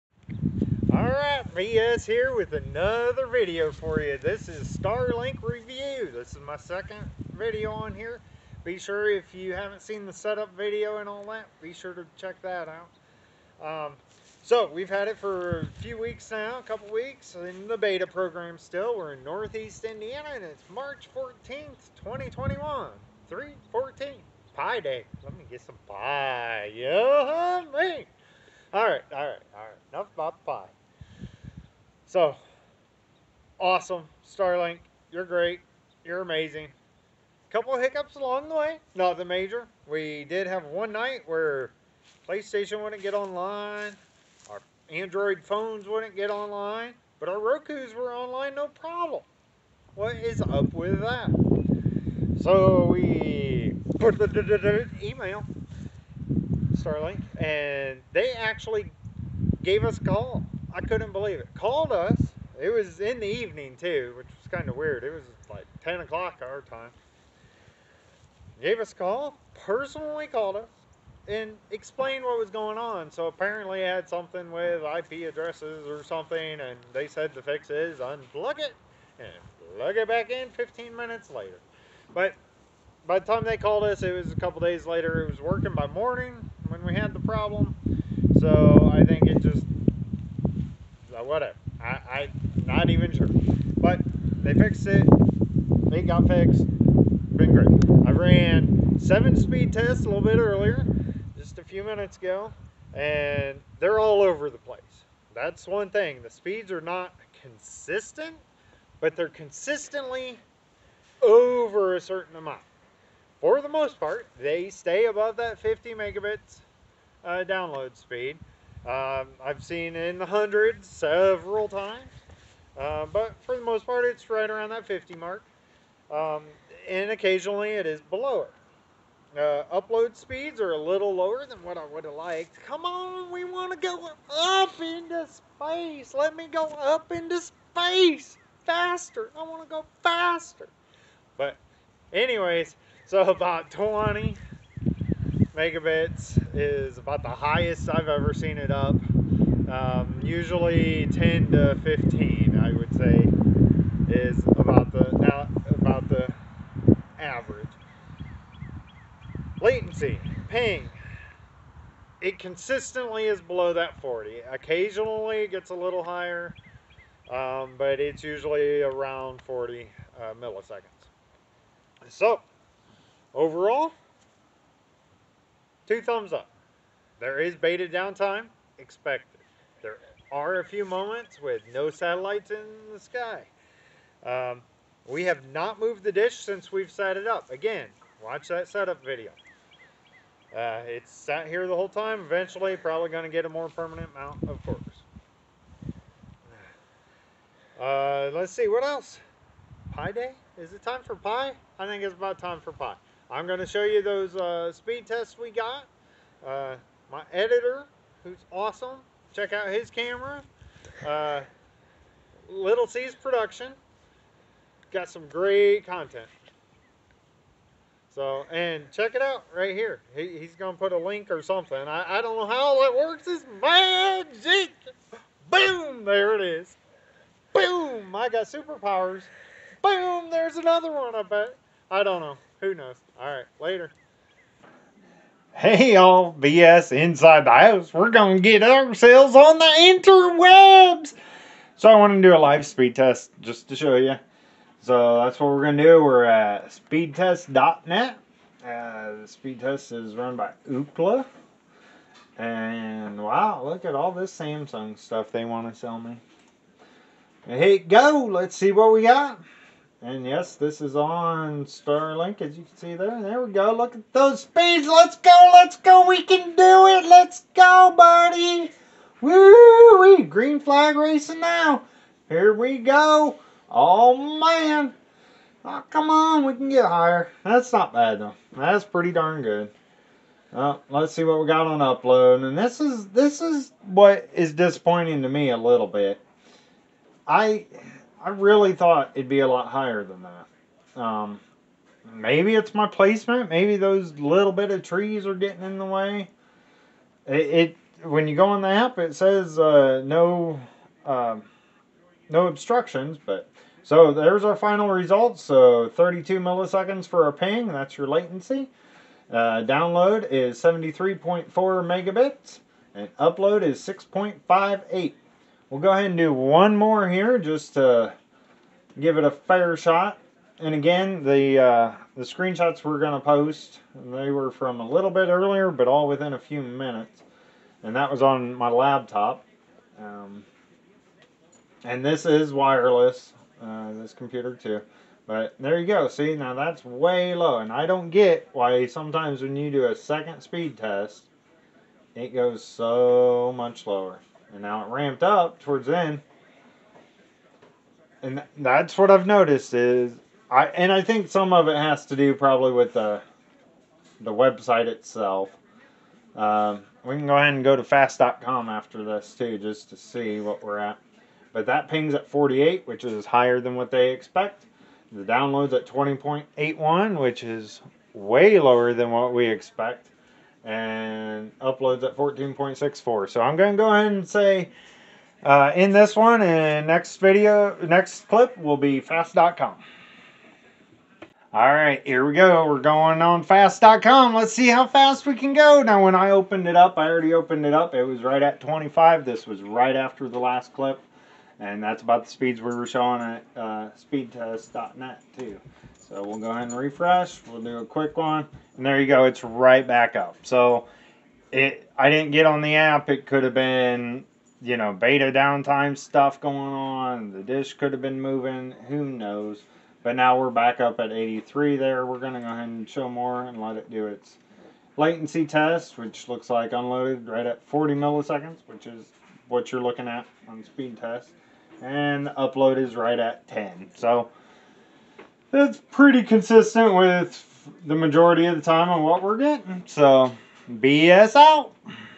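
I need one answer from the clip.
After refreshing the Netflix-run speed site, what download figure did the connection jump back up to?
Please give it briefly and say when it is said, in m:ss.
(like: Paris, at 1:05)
83, at 6:51.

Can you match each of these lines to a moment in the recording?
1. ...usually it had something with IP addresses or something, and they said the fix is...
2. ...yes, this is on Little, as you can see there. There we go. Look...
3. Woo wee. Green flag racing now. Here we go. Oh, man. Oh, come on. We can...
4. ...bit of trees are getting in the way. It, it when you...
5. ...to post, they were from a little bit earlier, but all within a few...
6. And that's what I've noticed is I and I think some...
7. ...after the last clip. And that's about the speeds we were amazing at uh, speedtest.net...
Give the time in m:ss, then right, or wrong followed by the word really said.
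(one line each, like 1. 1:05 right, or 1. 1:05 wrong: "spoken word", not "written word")
1. 1:13 wrong: "apparently", not "usually"
2. 4:20 wrong: "Starlink", not "Little"
3. 4:29 right
4. 4:54 right
5. 5:23 right
6. 5:48 right
7. 6:29 wrong: "showing", not "amazing".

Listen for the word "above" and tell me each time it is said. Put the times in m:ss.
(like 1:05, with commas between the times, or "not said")
1:55.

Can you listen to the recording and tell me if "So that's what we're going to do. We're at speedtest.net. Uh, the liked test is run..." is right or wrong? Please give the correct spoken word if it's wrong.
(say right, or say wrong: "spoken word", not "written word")
wrong: "speed", not "liked".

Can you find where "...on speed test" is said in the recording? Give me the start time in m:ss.
7:00.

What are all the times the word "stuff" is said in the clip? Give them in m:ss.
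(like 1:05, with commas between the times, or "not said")
4:14, 6:45.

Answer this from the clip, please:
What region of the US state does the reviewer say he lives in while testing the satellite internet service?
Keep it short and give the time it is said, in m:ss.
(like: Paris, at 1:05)
Northeast Indiana, at 0:19.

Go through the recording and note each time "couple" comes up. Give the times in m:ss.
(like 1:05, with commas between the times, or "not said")
0:16, 0:37, 1:24.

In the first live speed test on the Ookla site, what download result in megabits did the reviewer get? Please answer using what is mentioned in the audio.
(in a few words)
73.4.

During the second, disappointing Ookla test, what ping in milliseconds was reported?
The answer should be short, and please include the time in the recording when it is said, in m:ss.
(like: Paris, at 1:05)
48, at 6:02.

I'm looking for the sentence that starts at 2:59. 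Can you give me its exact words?
There are a few moments with no satellites in the sky.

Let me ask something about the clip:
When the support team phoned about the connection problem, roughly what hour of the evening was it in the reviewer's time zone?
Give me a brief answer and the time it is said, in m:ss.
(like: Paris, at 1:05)
10 o'clock, at 1:05.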